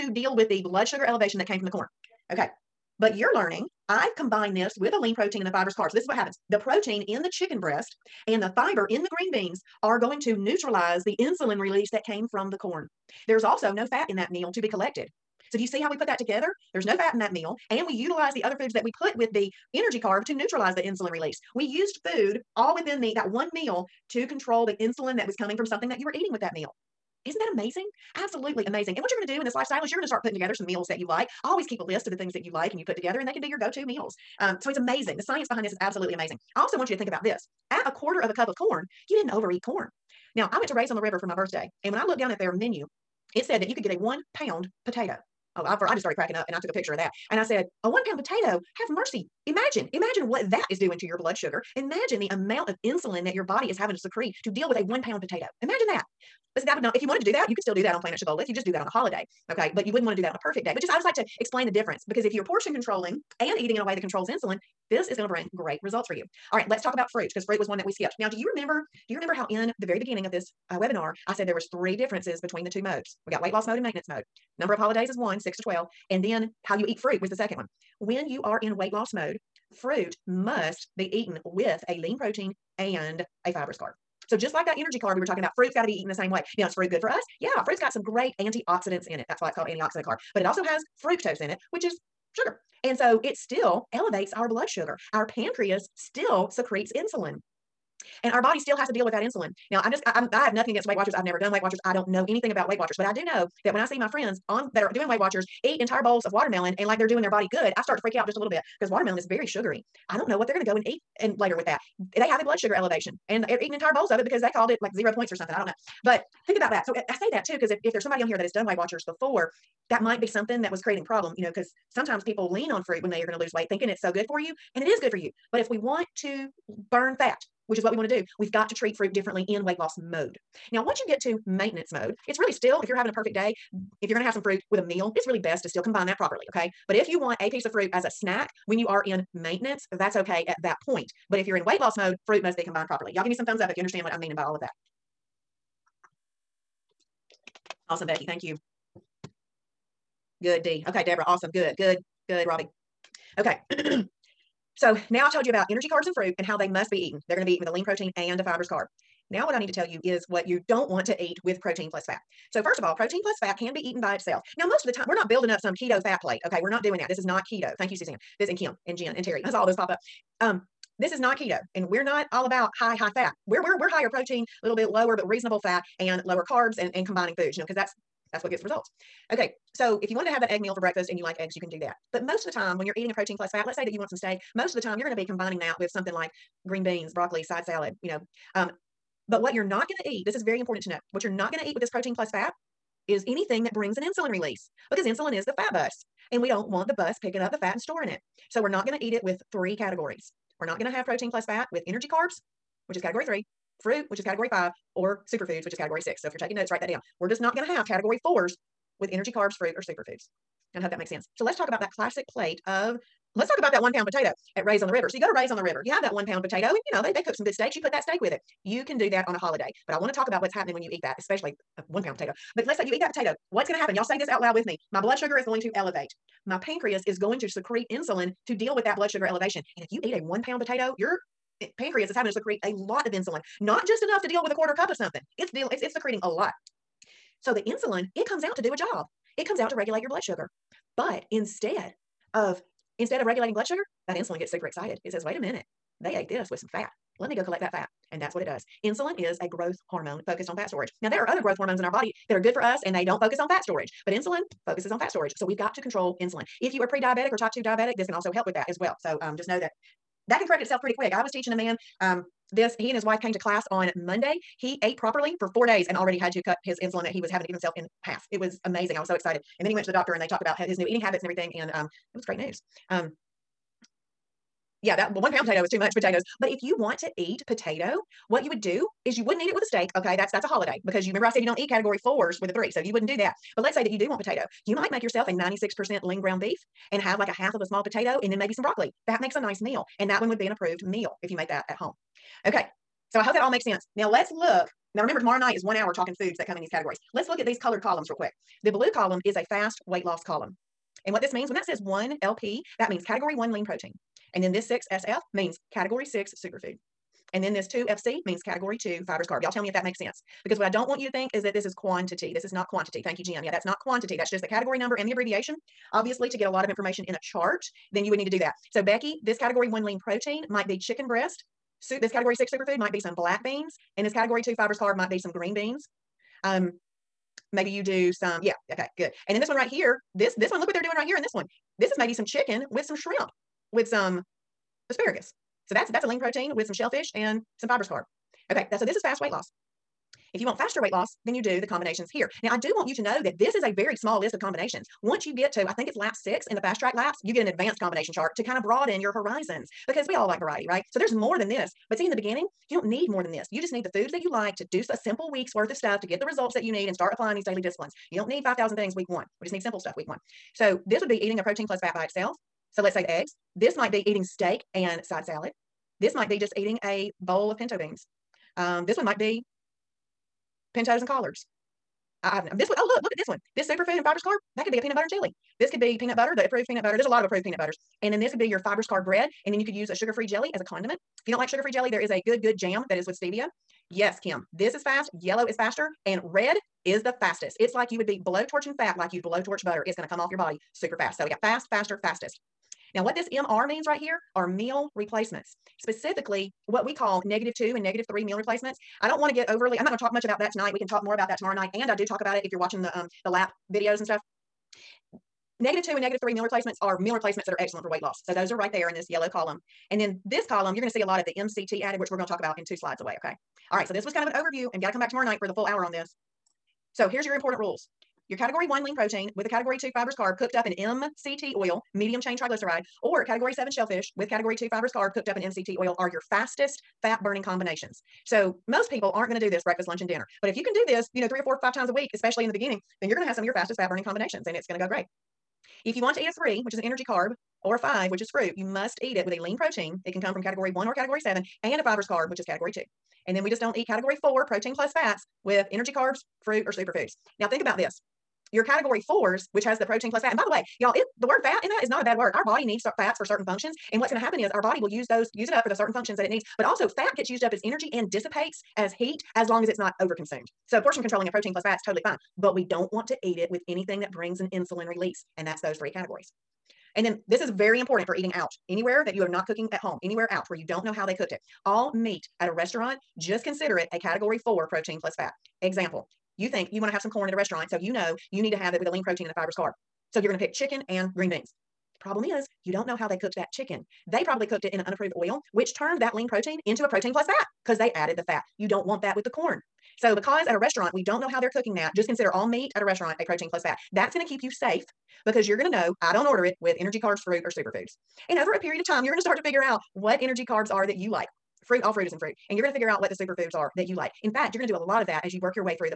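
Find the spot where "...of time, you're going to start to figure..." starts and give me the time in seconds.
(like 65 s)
498 s.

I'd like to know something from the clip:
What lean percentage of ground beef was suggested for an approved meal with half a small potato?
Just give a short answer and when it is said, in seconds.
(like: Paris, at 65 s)
96%, at 285 s.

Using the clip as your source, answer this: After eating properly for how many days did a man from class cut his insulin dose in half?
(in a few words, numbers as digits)
4 days.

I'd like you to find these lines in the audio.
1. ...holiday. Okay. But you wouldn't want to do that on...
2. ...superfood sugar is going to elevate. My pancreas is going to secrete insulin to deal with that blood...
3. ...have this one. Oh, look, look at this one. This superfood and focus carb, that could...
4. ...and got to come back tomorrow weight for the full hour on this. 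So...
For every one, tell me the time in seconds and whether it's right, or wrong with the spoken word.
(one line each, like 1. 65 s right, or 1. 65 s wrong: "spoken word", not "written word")
1. 58 s right
2. 224 s wrong: "blood", not "superfood"
3. 372 s wrong: "fibrous", not "focus"
4. 414 s wrong: "night", not "weight".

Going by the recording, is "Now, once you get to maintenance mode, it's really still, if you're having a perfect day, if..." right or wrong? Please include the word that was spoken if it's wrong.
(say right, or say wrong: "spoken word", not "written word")
right.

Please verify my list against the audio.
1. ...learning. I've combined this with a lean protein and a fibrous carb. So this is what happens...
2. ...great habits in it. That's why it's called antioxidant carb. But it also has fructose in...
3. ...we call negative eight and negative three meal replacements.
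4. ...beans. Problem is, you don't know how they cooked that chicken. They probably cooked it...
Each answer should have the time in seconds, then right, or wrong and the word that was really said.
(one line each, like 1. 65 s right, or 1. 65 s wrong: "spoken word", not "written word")
1. 3 s right
2. 88 s wrong: "antioxidants", not "habits"
3. 396 s wrong: "two", not "eight"
4. 481 s right.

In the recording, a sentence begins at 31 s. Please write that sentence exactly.
Always keep a list of the things that you like and you put together, and they can be your go to meals.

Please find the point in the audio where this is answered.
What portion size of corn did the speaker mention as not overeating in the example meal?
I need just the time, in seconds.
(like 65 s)
37 s.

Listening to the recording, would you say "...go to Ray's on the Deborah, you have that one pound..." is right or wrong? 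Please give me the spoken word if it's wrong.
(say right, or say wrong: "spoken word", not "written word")
wrong: "River", not "Deborah".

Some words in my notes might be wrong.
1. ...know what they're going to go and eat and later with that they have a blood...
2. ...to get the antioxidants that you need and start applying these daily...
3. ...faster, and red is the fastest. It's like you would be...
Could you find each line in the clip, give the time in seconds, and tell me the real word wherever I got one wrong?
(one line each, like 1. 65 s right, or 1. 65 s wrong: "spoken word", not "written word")
1. 110 s right
2. 356 s wrong: "results", not "antioxidants"
3. 385 s right.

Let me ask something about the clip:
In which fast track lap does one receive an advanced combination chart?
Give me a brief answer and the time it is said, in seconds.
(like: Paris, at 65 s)
Lap 6, at 345 s.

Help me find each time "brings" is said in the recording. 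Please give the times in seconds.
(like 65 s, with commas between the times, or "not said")
65 s, 193 s, 464 s.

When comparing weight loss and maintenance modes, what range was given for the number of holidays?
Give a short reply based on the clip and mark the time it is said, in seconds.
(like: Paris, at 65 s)
6 to 12, at 75 s.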